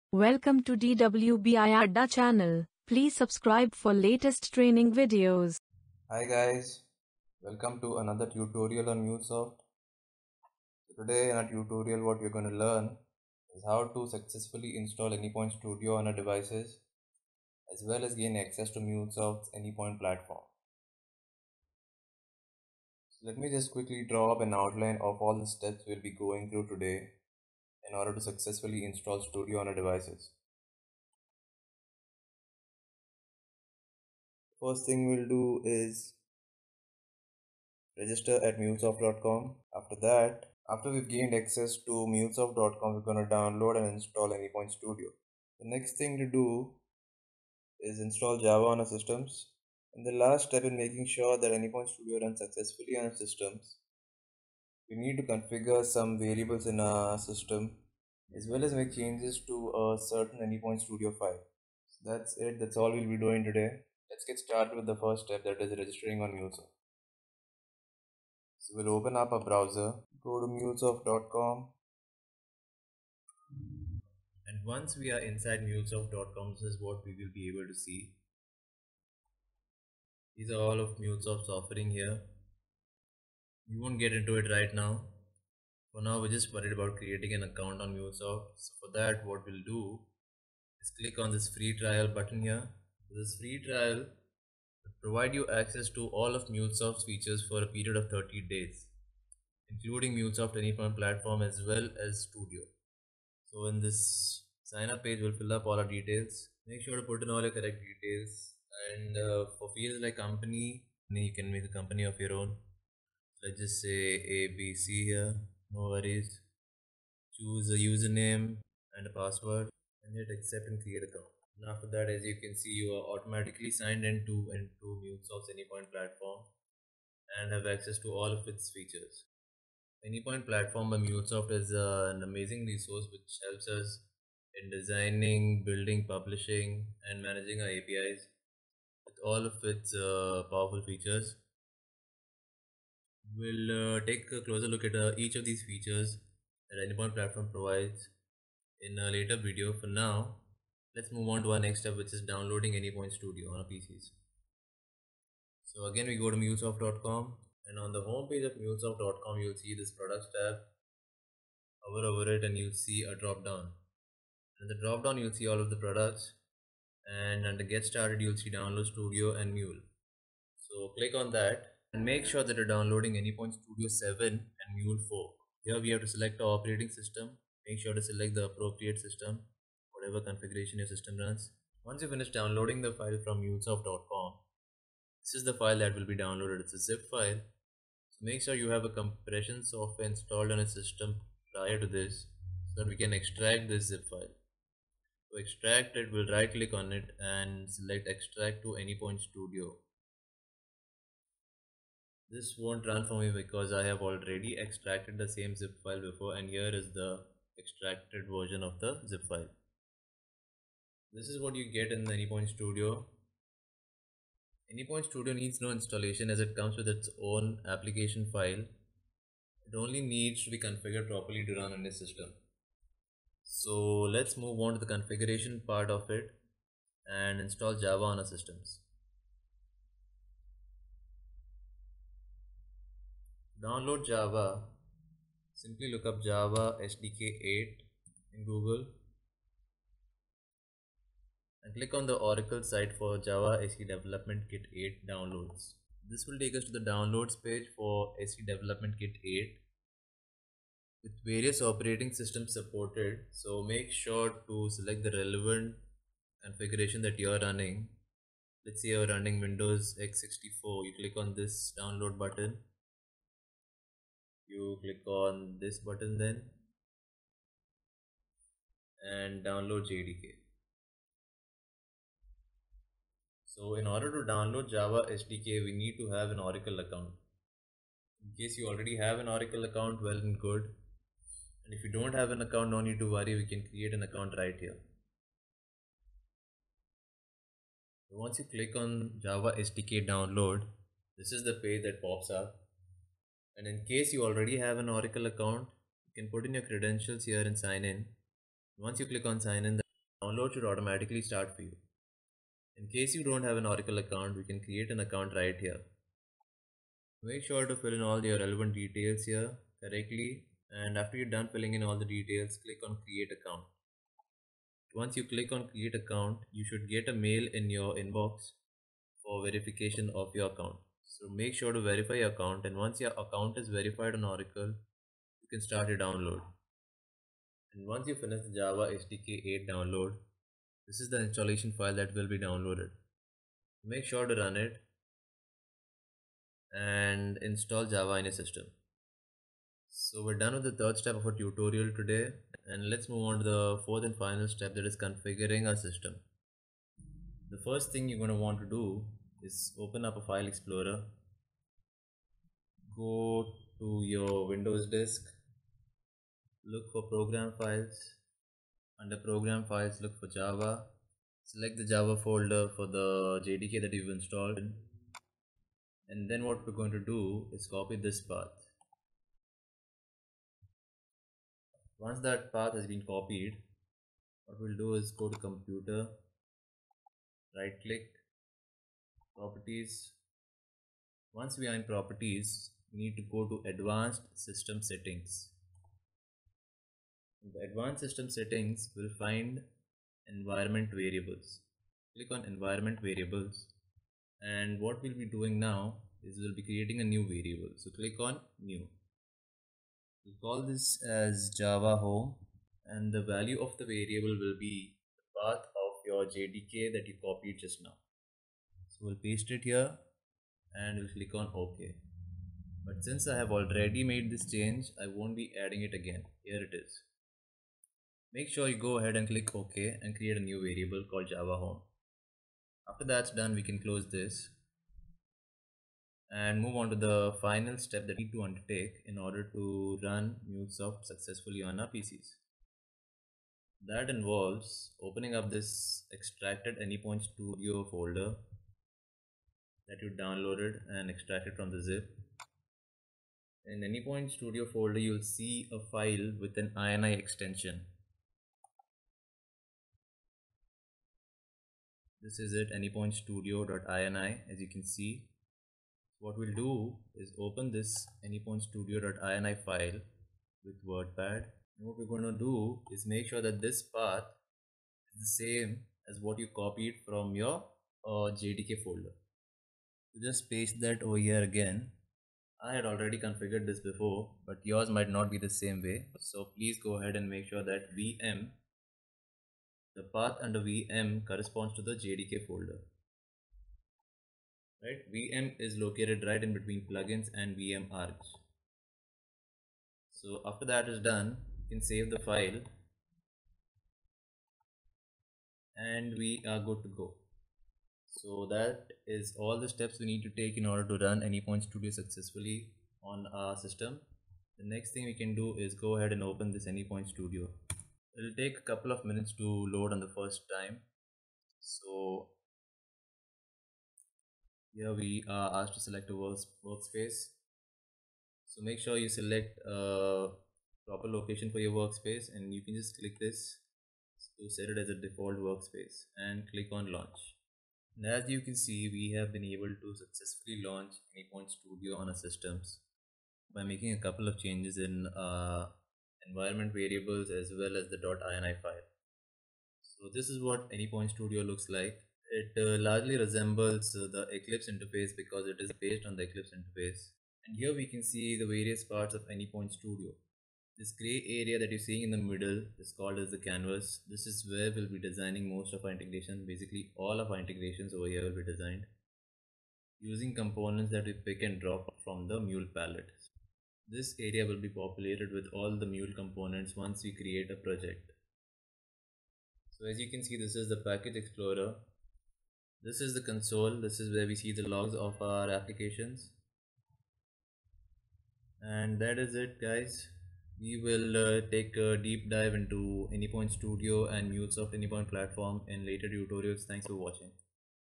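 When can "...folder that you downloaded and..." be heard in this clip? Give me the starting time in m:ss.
7:17.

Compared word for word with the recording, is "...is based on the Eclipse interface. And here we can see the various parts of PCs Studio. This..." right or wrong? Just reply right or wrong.
wrong.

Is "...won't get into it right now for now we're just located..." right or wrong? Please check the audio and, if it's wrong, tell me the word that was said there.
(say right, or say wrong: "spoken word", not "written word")
wrong: "worried", not "located".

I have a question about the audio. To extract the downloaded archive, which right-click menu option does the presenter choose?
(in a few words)
Extract to Anypoint Studio.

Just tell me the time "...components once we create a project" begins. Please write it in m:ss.
9:26.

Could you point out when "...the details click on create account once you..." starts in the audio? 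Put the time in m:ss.
5:12.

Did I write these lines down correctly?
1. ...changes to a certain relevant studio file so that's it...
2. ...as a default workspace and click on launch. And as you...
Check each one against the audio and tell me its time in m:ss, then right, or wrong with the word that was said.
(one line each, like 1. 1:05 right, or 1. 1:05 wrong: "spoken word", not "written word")
1. 0:58 wrong: "anypoint", not "relevant"
2. 8:44 right.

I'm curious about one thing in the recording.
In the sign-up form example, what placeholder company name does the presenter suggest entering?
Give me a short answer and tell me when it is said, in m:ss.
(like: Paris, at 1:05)
abc, at 1:54.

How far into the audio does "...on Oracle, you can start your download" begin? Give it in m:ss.
5:24.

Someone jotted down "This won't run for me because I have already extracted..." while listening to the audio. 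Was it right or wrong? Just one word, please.
right.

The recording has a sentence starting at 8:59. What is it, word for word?
So this is what Anypoint Studio looks like.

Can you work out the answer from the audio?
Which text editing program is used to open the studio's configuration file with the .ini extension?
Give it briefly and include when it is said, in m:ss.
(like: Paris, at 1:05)
WordPad, at 7:40.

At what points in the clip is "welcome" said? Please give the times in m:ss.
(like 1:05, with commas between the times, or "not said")
0:00, 0:07.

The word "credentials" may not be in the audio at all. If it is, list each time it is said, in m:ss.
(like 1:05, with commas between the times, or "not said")
4:56.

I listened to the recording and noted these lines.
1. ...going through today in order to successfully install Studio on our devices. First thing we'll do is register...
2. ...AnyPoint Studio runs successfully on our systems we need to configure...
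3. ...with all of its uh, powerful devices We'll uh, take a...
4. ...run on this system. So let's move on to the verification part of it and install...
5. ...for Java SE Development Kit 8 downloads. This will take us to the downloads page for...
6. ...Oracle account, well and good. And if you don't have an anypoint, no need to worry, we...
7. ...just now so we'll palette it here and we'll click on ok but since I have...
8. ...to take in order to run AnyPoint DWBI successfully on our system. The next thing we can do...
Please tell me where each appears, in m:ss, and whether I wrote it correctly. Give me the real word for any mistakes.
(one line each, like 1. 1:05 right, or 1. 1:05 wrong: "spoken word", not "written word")
1. 0:26 right
2. 0:51 right
3. 2:19 wrong: "features", not "devices"
4. 3:41 wrong: "configuration", not "verification"
5. 4:02 right
6. 4:39 wrong: "account", not "anypoint"
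7. 6:47 wrong: "paste", not "palette"
8. 8:20 wrong: "Studio", not "DWBI".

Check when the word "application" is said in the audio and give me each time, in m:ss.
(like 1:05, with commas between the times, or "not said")
3:37, 9:35.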